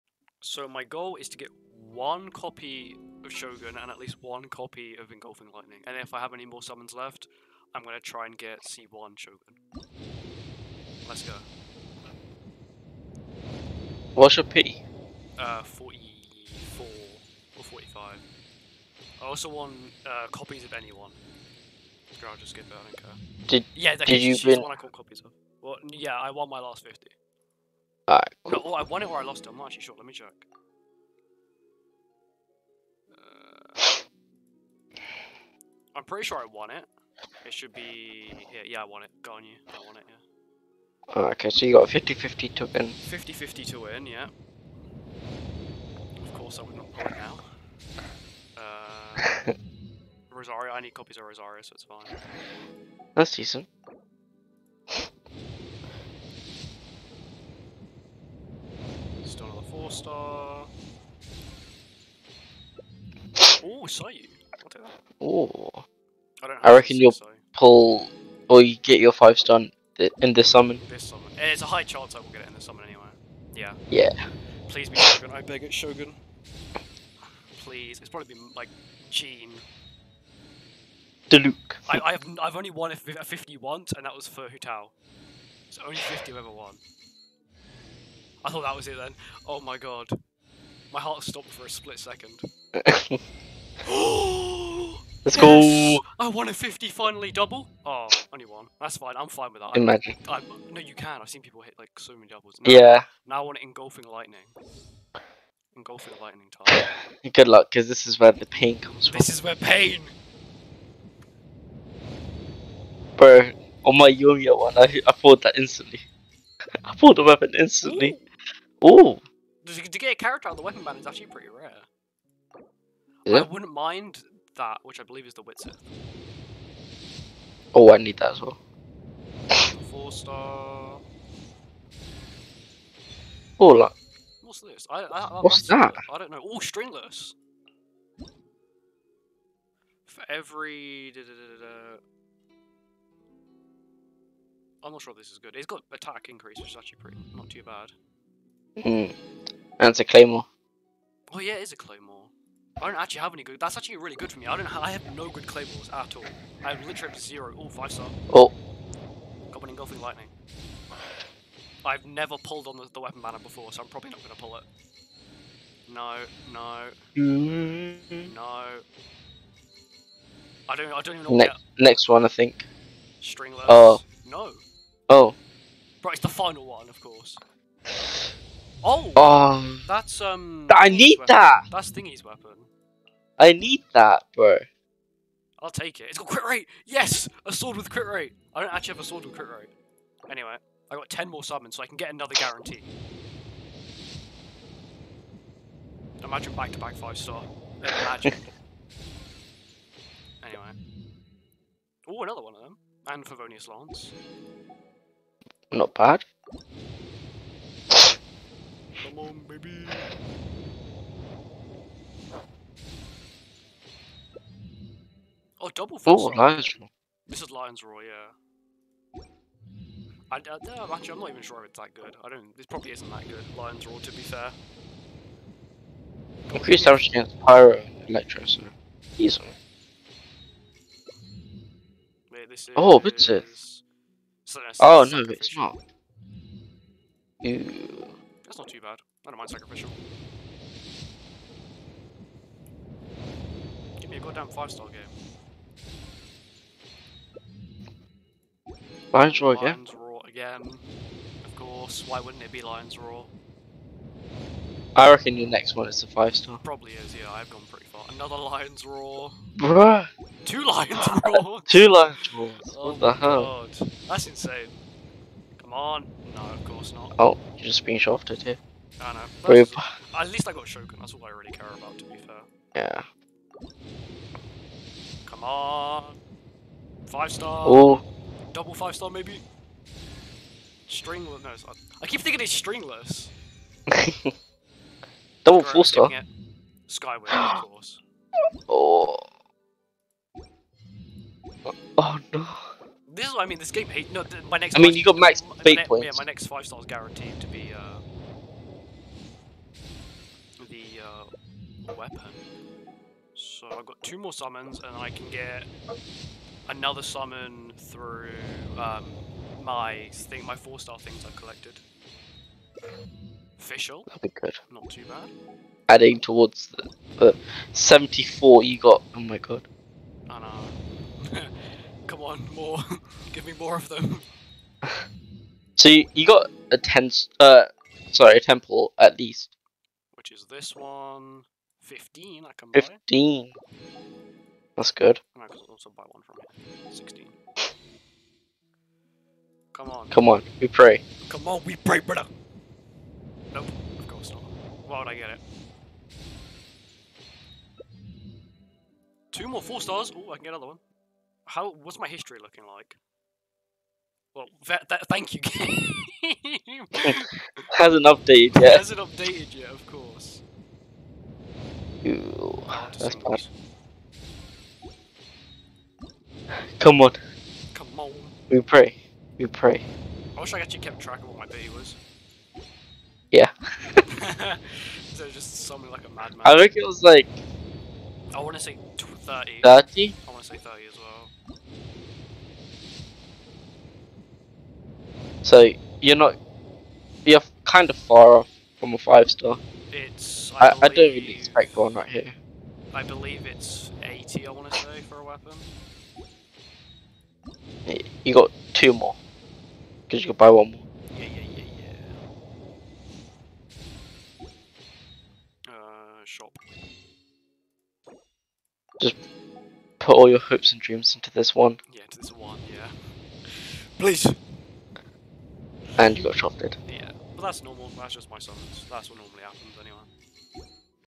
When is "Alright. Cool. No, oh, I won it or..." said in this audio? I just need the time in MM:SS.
00:28.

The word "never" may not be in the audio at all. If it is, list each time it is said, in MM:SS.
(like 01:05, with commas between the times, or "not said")
02:42.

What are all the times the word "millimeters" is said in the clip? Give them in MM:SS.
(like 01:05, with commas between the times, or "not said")
not said.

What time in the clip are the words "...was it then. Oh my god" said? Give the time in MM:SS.
01:28.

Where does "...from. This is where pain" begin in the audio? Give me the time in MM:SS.
01:49.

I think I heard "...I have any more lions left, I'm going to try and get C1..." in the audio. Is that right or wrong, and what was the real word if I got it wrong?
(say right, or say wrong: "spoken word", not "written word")
wrong: "summons", not "lions".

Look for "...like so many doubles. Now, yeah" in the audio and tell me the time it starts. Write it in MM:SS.
01:41.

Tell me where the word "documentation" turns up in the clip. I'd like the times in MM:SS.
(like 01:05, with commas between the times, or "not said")
not said.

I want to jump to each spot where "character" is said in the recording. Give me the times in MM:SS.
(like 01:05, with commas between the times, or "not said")
02:00.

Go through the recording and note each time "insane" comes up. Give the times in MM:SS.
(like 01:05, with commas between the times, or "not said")
04:24.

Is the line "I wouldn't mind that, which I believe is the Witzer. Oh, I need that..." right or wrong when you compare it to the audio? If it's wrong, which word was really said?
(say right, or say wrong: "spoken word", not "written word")
right.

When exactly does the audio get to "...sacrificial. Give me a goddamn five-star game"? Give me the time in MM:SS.
03:59.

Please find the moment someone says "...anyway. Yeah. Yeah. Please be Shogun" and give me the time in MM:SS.
01:12.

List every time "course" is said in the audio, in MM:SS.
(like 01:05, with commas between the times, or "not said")
00:46, 02:57, 04:11, 04:26, 04:47, 05:44, 05:59.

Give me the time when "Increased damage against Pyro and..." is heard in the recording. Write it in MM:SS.
03:46.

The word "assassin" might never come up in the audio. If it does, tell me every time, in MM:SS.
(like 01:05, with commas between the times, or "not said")
not said.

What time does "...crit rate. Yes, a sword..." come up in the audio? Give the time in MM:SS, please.
03:06.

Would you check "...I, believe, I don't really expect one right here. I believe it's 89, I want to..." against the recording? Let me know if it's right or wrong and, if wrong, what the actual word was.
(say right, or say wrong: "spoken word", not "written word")
wrong: "80", not "89".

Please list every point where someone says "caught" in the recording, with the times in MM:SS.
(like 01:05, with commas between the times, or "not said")
00:24.